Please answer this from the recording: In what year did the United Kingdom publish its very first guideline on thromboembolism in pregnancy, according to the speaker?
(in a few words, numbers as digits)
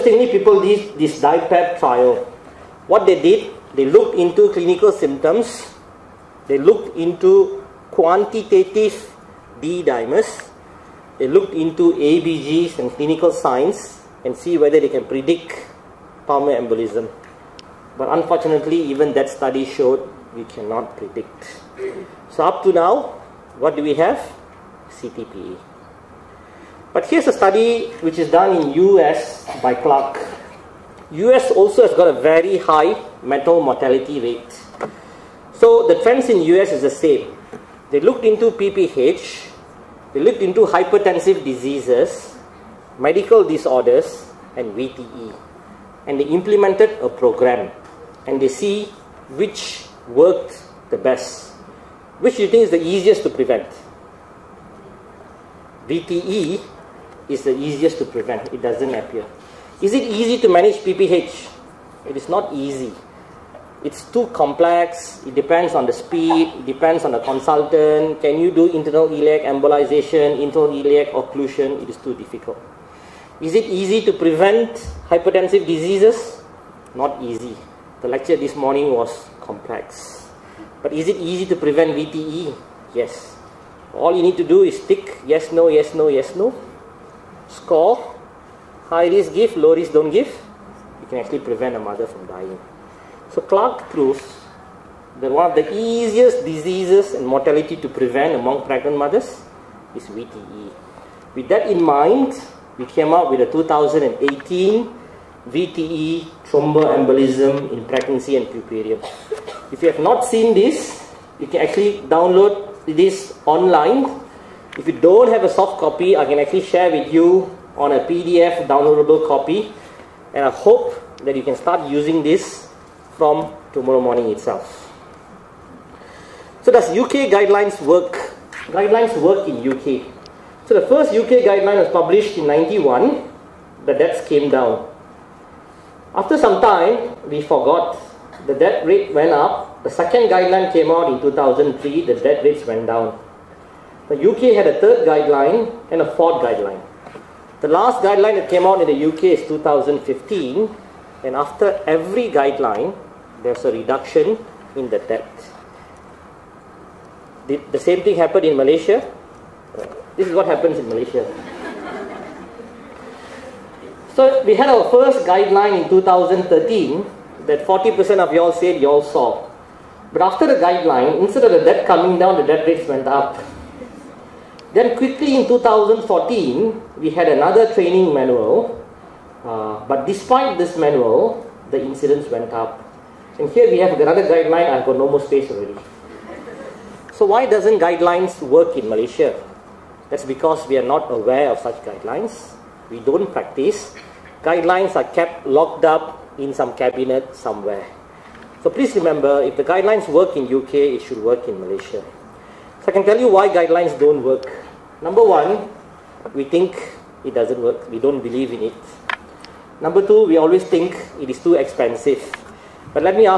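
1991.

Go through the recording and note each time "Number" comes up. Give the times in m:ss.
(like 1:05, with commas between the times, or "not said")
3:25, 3:29.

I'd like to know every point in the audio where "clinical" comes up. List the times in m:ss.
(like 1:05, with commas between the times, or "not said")
0:04, 0:12.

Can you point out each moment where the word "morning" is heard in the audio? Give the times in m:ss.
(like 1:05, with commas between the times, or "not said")
1:18, 2:04.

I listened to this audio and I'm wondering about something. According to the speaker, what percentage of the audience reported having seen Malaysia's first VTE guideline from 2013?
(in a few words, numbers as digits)
40%.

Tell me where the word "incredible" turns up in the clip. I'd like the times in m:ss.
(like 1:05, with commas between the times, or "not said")
not said.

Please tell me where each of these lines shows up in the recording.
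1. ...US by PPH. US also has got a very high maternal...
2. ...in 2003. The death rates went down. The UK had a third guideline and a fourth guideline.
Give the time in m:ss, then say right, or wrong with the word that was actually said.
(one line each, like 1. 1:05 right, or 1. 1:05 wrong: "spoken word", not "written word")
1. 0:28 wrong: "Clark", not "PPH"
2. 2:21 right.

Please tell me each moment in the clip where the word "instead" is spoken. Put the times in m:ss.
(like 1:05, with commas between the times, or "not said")
2:51.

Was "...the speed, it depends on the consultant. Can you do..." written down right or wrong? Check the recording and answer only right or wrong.
right.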